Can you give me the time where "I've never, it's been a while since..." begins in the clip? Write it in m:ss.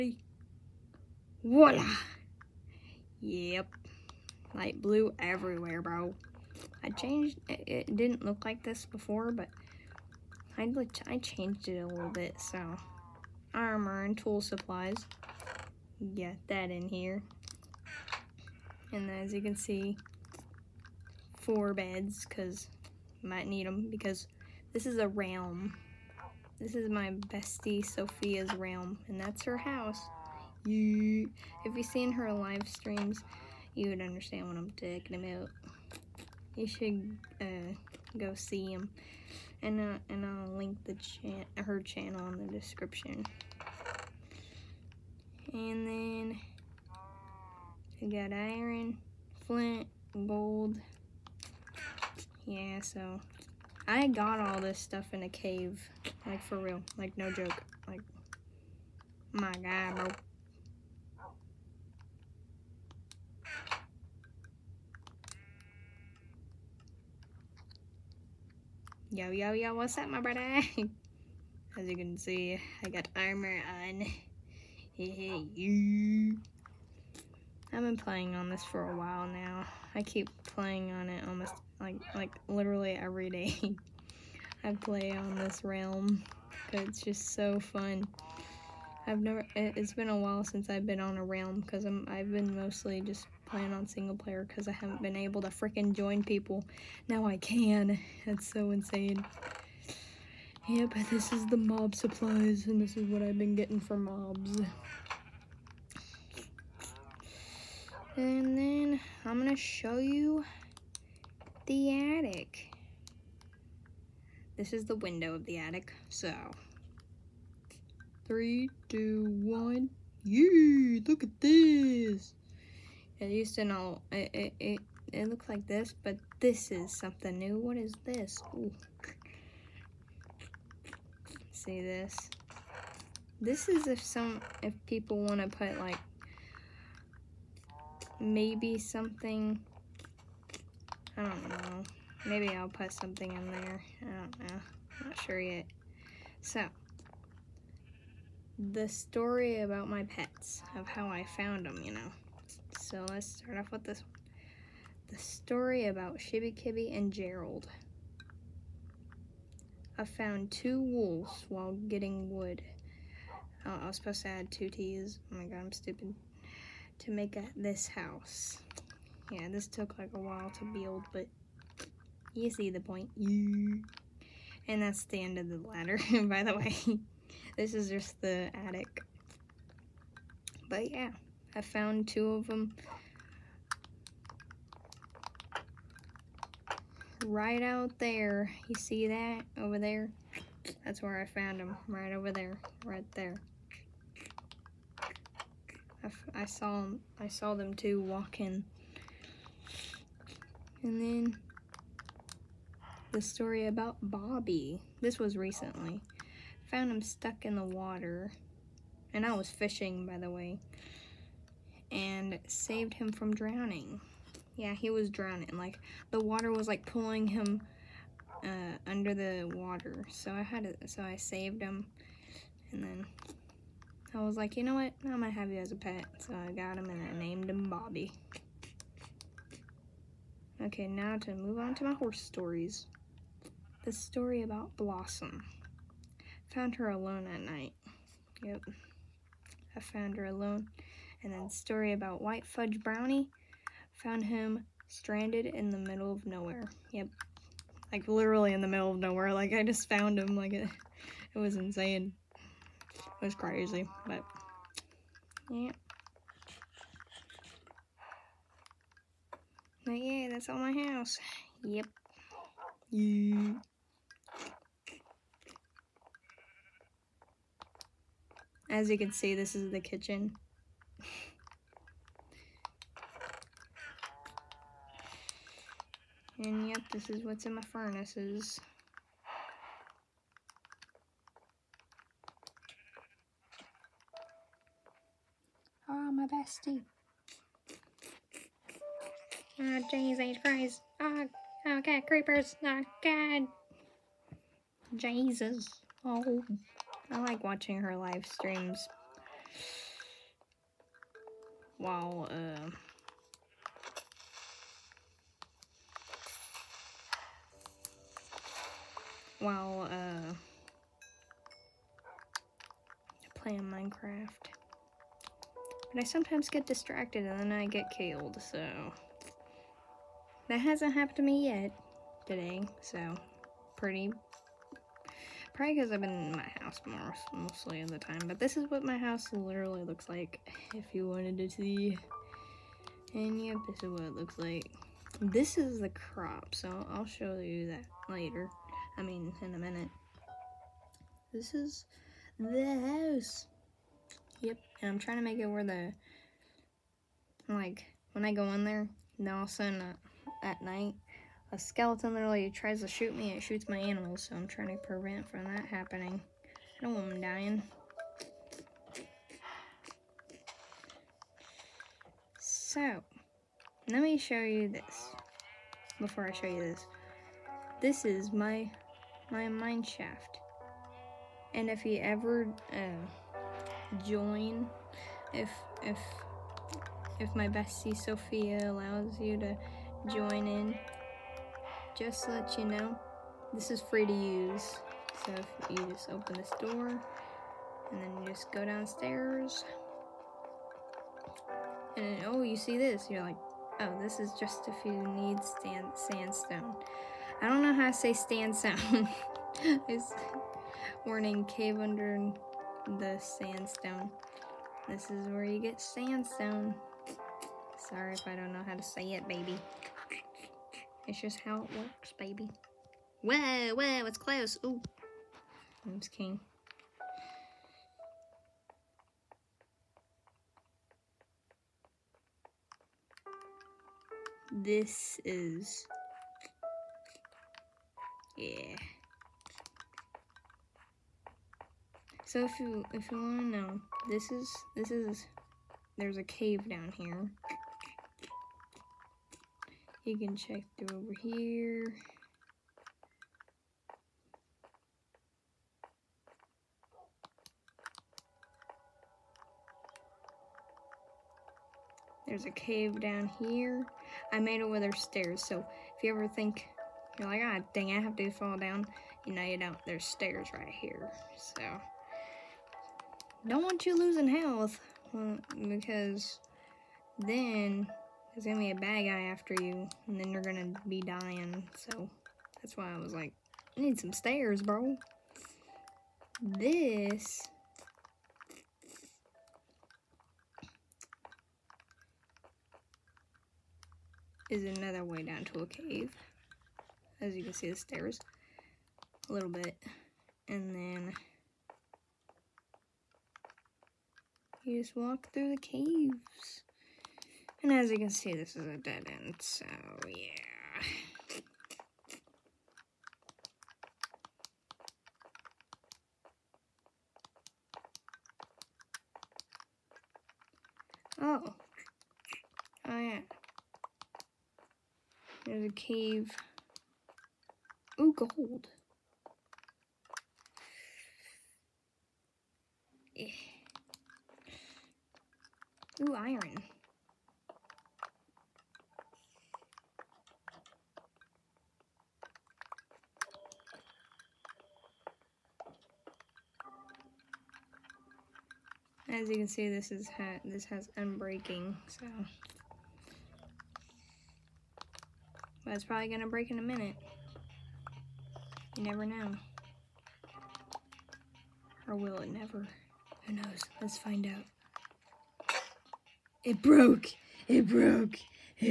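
1:29.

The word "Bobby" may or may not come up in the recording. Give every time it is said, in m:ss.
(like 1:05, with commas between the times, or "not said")
3:24, 3:47.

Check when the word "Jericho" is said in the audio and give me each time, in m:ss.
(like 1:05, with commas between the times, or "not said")
not said.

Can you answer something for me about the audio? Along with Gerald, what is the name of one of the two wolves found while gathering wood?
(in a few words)
Shibby Kibby.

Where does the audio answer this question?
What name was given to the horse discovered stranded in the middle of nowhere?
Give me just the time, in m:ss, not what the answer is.
4:02.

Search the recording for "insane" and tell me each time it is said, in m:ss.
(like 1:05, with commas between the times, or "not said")
1:38, 4:11.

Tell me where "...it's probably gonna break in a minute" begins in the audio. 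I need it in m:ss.
9:05.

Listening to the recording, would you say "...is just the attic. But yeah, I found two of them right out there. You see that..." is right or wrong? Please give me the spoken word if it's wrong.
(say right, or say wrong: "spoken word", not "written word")
right.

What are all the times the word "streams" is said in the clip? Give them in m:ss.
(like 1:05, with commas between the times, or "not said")
0:32, 4:58.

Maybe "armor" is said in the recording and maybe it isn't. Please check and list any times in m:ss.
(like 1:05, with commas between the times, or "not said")
0:13, 1:13.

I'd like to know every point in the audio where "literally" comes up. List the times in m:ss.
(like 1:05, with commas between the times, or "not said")
1:22, 4:08, 5:29, 5:52.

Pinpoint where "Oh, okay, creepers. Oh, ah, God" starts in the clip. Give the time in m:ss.
4:50.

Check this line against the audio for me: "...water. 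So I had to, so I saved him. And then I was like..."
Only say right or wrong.
right.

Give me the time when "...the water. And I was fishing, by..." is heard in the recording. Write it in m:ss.
3:27.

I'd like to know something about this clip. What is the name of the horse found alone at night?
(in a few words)
Blossom.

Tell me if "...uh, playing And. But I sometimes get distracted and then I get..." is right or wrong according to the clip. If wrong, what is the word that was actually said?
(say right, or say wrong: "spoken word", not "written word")
wrong: "Minecraft", not "And".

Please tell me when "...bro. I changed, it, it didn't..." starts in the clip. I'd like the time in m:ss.
0:05.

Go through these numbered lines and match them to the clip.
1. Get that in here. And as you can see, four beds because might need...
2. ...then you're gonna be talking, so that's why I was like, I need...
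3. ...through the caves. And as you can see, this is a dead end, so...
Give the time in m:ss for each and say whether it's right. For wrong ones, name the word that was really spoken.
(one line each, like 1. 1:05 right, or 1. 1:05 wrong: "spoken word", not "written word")
1. 0:16 right
2. 7:50 wrong: "dying", not "talking"
3. 8:15 right.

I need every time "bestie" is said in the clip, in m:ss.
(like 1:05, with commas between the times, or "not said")
0:27, 4:46, 6:17.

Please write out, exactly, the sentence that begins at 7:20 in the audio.
You can check through over here.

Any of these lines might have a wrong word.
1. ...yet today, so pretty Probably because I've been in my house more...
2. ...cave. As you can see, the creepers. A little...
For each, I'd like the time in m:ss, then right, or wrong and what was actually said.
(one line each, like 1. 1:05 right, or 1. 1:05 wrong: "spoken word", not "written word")
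1. 5:21 right
2. 8:05 wrong: "stairs", not "creepers".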